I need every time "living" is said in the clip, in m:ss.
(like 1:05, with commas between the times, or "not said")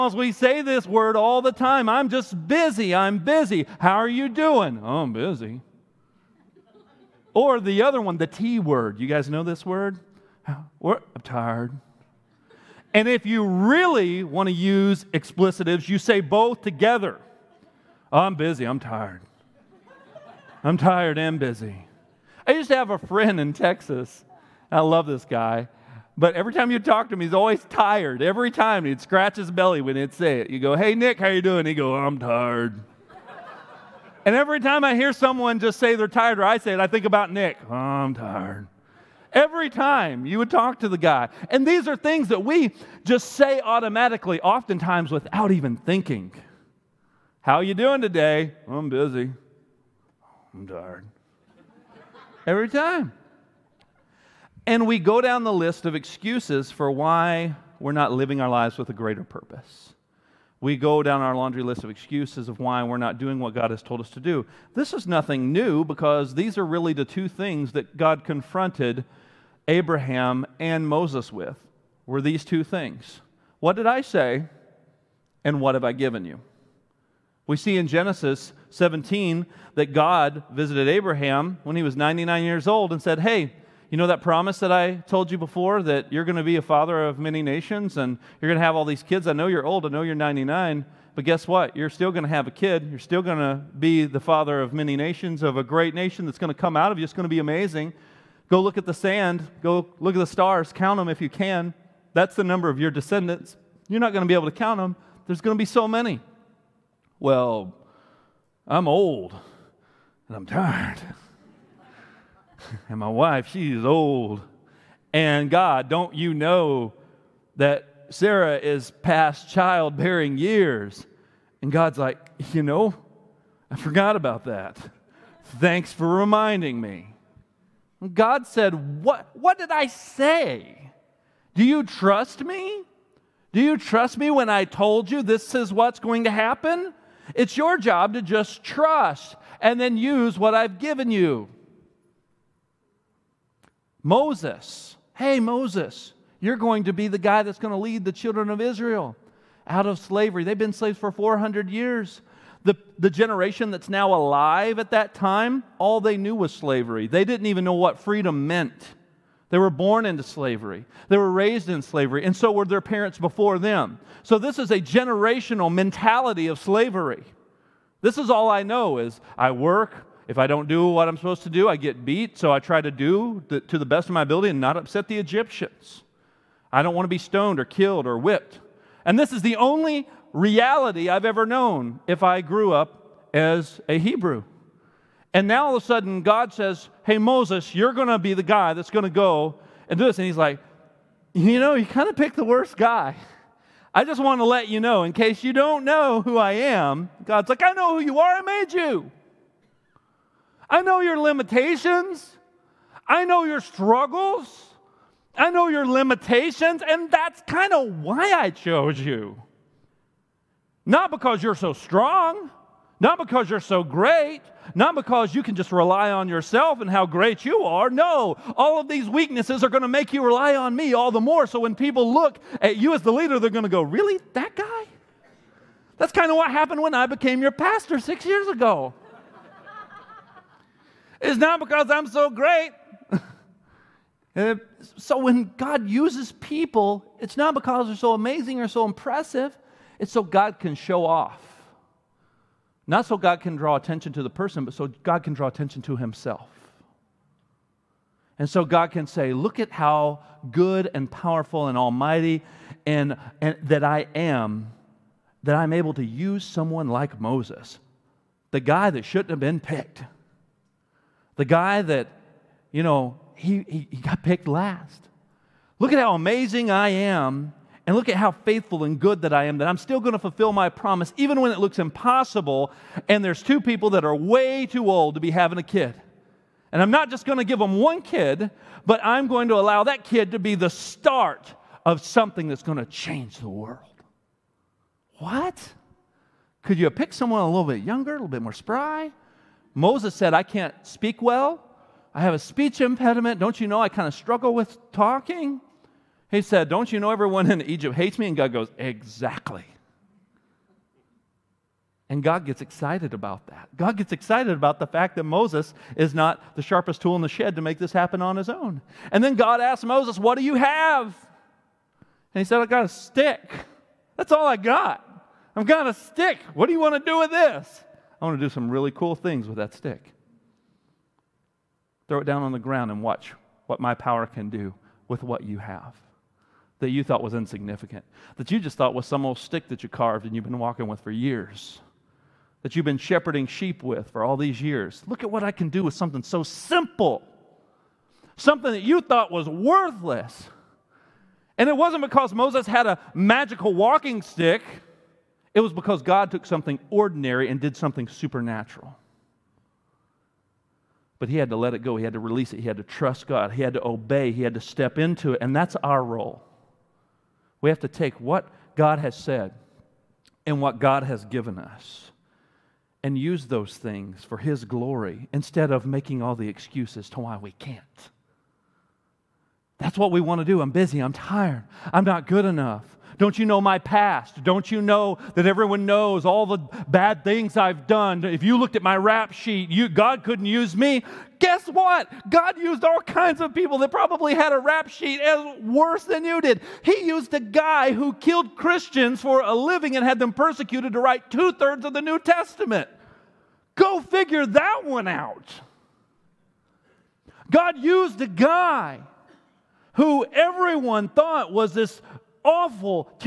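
0:58, 6:29.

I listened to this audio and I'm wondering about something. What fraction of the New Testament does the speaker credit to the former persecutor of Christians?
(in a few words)
Two thirds.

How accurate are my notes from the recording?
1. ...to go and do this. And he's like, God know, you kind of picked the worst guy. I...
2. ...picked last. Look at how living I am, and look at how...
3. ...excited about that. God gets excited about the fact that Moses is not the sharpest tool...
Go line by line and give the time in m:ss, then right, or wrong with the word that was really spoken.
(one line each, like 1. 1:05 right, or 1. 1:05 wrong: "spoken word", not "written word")
1. 3:09 wrong: "You", not "God"
2. 4:24 wrong: "amazing", not "living"
3. 5:02 right.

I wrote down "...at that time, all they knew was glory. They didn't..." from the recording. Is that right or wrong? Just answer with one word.
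wrong.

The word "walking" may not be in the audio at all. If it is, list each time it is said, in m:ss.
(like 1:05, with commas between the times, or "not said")
5:30, 5:43.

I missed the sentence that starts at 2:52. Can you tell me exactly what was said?
So I try to do the, to the best of my ability and not upset the Egyptians.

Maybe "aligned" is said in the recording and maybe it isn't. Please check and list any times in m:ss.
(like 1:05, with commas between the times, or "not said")
not said.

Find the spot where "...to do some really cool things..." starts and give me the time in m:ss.
5:18.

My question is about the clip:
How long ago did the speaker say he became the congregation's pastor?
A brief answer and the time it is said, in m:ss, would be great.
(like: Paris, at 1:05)
6 years ago, at 3:47.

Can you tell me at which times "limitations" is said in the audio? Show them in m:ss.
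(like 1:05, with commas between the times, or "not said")
3:21, 3:25.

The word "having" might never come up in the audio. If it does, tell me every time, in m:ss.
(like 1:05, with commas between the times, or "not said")
4:35.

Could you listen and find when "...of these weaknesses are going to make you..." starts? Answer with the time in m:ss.
3:38.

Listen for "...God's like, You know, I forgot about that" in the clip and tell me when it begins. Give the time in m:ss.
2:01.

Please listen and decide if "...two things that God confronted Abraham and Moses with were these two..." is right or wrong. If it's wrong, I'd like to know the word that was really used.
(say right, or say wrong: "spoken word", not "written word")
right.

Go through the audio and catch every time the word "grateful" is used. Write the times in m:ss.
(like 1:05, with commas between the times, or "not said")
not said.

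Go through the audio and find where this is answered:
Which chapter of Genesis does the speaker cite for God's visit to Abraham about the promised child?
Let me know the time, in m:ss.
1:17.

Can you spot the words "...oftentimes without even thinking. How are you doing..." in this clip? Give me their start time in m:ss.
0:44.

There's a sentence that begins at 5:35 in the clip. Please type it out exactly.
Look at what I can do with something so simple, something that you thought was worthless.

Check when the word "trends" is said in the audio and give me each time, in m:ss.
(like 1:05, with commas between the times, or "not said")
not said.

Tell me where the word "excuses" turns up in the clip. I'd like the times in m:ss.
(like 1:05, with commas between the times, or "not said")
0:55, 1:01, 6:06.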